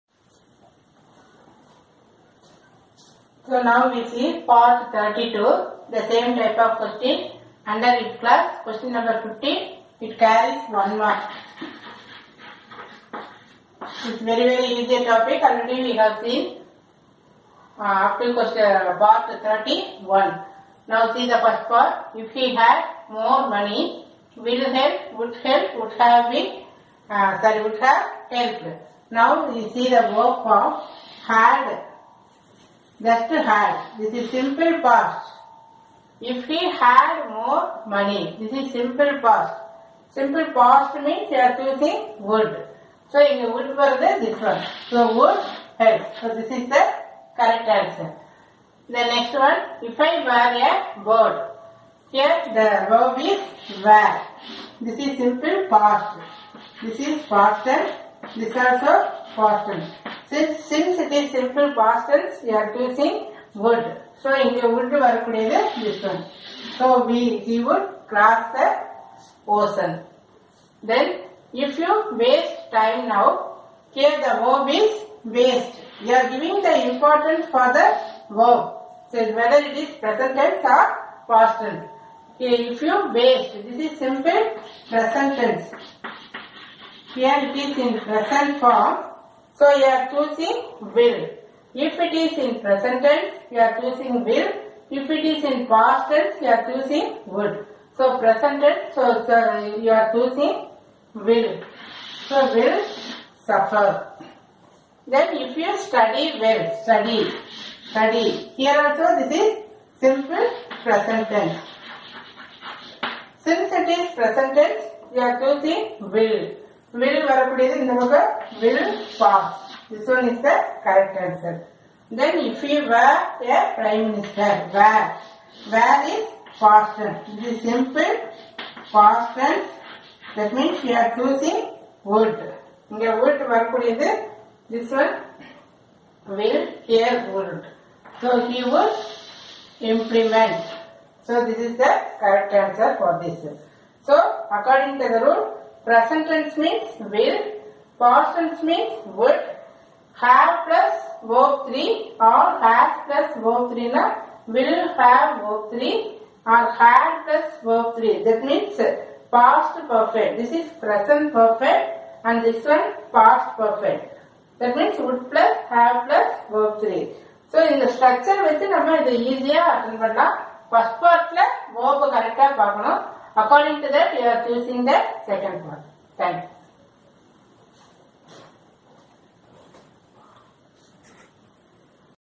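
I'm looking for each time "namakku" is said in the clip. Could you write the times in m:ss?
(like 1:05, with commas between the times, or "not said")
1:57.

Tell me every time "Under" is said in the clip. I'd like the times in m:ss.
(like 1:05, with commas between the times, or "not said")
0:07.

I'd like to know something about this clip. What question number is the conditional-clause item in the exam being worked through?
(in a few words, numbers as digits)
15.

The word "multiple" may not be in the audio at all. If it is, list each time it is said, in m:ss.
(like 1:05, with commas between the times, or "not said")
not said.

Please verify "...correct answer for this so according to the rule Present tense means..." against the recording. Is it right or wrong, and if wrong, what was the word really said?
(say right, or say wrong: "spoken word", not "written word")
right.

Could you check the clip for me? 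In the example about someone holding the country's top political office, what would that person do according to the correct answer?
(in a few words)
implement.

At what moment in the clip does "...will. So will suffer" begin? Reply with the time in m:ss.
1:41.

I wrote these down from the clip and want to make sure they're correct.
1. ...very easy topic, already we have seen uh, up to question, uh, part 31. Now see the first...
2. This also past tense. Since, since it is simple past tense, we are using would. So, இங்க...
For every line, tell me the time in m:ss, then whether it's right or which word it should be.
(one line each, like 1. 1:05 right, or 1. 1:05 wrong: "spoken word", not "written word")
1. 0:14 right
2. 0:58 right.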